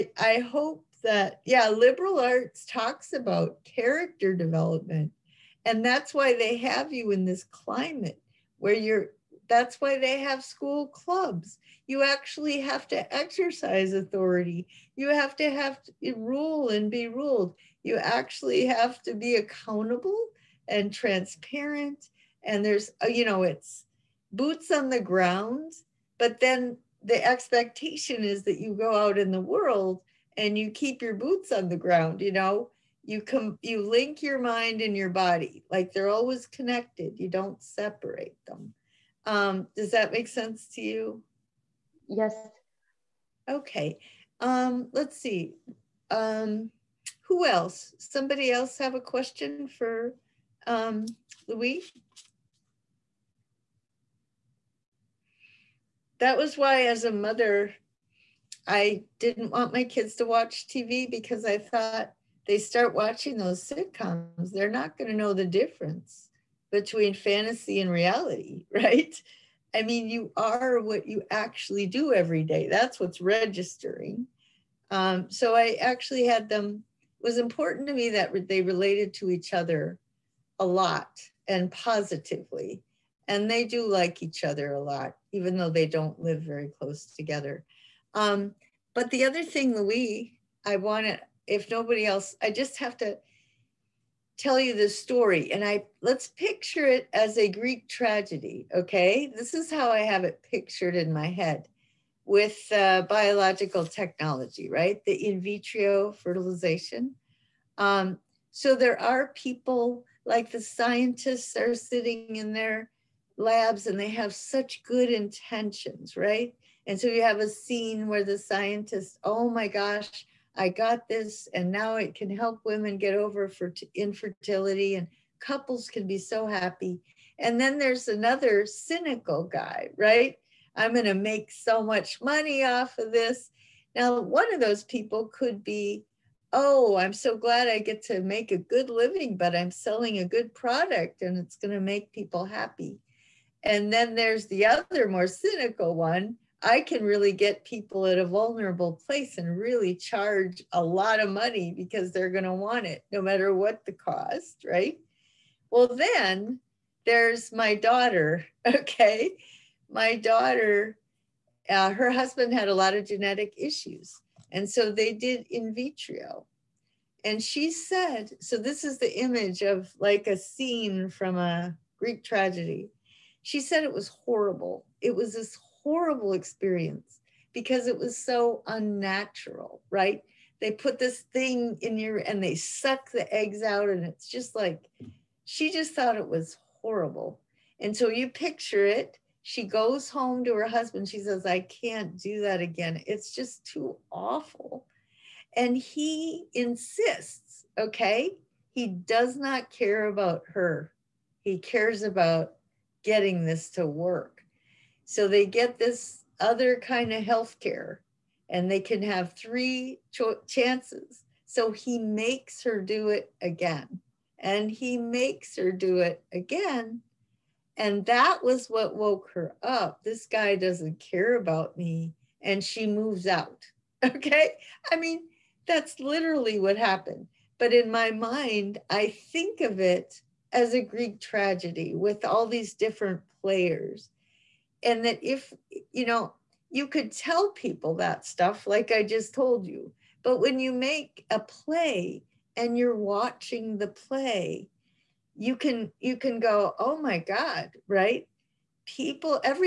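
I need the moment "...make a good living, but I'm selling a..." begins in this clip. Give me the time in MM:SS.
02:18.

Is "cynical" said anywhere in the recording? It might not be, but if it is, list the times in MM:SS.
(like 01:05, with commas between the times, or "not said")
02:08, 02:25.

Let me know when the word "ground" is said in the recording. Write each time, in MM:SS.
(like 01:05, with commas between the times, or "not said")
00:24, 00:31.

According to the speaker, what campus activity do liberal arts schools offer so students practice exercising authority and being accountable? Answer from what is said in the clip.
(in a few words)
school clubs.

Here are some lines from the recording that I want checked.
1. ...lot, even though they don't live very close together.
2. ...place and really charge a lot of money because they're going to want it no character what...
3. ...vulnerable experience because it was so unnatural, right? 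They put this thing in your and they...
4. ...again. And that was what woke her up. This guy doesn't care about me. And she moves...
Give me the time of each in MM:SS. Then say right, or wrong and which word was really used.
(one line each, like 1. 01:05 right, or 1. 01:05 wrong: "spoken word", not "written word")
1. 01:24 right
2. 02:29 wrong: "matter", not "character"
3. 02:55 wrong: "horrible", not "vulnerable"
4. 03:36 right.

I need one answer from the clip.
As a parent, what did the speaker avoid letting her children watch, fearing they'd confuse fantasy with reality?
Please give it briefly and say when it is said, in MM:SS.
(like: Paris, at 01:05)
TV, at 01:00.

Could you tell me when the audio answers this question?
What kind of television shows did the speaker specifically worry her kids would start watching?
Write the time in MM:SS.
01:03.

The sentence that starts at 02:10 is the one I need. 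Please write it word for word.
I'm going to make so much money off of this.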